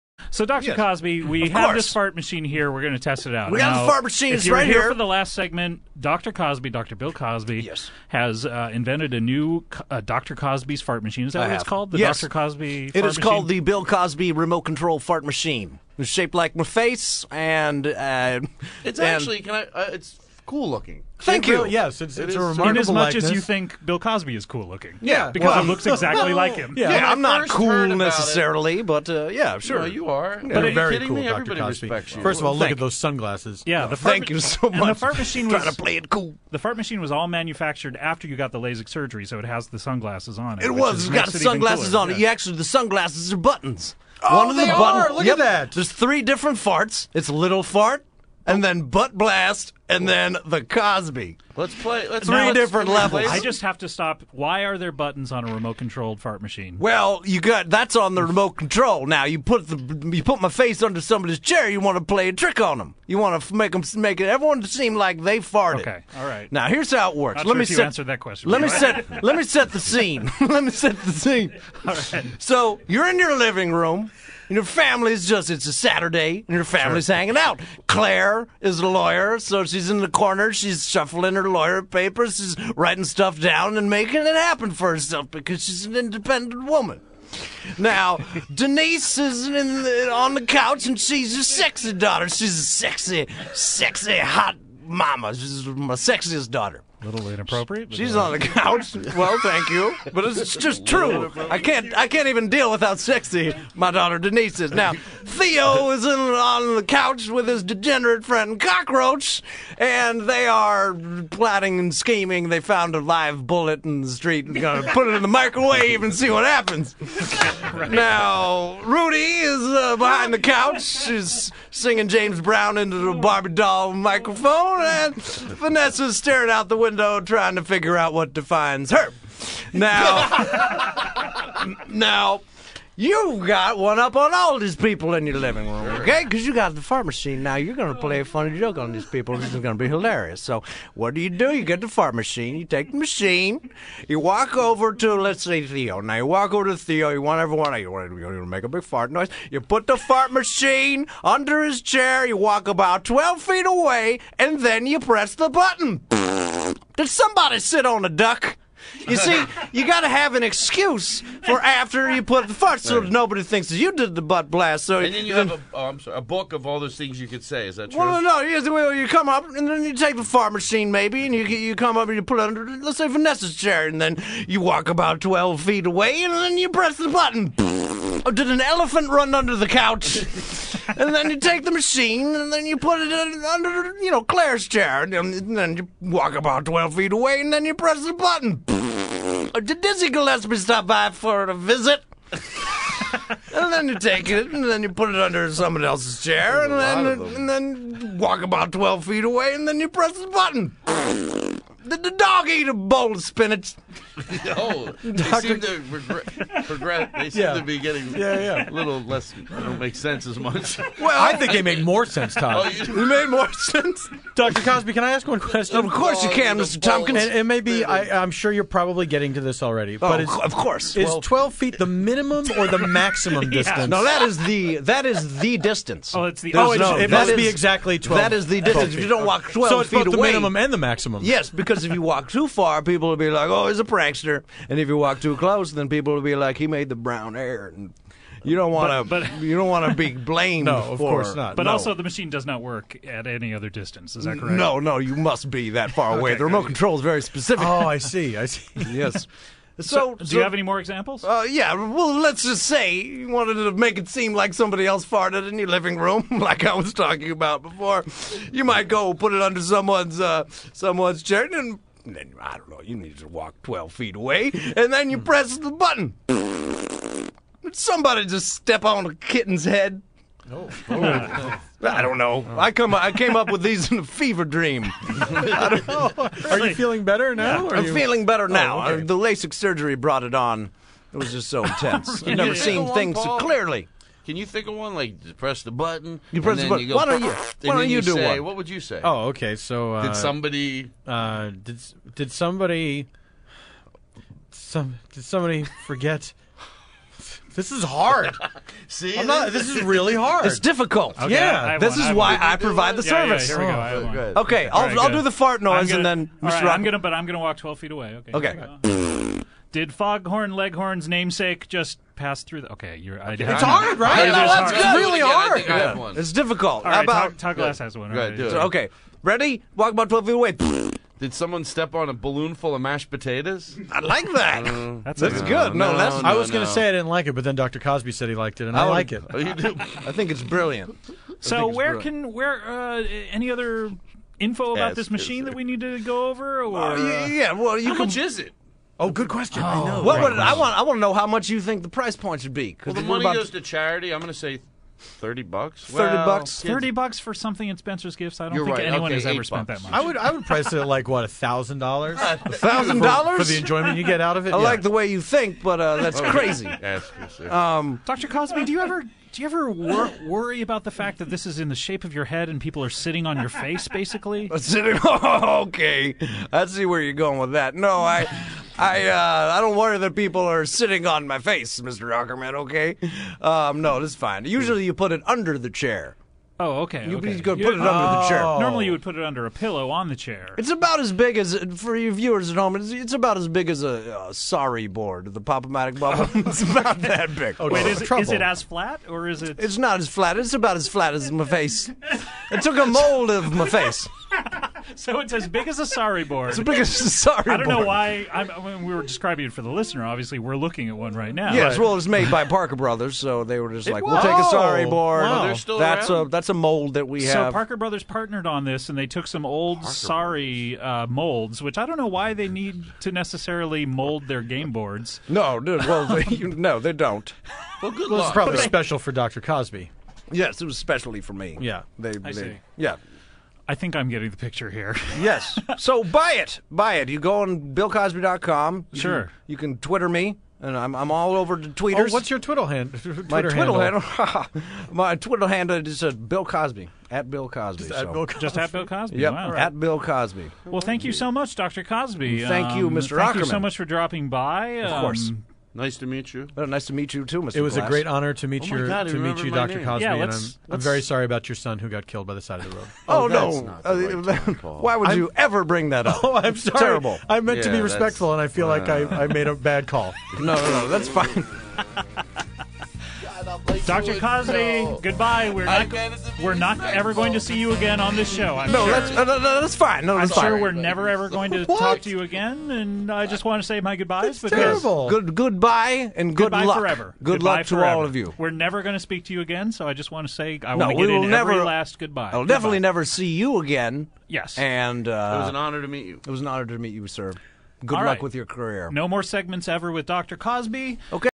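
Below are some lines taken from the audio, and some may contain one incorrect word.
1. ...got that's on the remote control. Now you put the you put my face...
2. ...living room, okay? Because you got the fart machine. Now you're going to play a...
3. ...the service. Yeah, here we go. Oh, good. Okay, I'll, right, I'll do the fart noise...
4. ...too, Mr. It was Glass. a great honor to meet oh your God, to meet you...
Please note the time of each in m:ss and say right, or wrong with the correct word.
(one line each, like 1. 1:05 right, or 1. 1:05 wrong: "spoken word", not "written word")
1. 0:57 right
2. 2:15 right
3. 5:02 right
4. 7:27 right.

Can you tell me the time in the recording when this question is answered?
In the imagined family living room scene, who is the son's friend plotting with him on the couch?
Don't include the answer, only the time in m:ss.
1:48.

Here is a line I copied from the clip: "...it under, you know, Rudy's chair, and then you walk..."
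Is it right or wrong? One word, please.
wrong.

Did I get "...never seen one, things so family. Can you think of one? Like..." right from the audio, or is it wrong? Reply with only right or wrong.
wrong.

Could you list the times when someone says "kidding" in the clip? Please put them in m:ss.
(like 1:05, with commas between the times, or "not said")
0:30.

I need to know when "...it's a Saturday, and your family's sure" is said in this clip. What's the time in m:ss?
1:15.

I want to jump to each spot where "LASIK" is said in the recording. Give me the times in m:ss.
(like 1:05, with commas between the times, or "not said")
0:38, 4:39.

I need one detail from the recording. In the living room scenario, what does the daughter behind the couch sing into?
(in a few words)
Barbie doll microphone.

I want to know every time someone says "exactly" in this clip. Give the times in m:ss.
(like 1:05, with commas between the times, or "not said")
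0:25, 3:47.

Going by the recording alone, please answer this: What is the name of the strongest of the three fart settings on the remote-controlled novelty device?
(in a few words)
The Cosby.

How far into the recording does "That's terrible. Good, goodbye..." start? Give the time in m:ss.
7:54.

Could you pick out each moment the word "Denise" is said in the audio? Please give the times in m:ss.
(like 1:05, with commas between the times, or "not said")
1:28, 1:44.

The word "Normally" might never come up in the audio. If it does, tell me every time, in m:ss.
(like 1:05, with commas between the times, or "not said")
6:18.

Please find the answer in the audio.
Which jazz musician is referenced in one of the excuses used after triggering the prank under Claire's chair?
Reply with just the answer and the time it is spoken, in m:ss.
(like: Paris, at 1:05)
Dizzy Gillespie, at 3:09.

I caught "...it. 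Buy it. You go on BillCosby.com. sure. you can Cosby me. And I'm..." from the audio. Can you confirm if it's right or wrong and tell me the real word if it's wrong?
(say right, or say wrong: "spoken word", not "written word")
wrong: "Twitter", not "Cosby".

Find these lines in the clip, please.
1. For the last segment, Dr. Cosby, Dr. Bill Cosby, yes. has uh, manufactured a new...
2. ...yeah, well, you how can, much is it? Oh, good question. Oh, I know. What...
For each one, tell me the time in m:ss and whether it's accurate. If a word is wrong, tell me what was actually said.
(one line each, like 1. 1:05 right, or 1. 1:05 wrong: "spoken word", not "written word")
1. 0:04 wrong: "invented", not "manufactured"
2. 5:37 right.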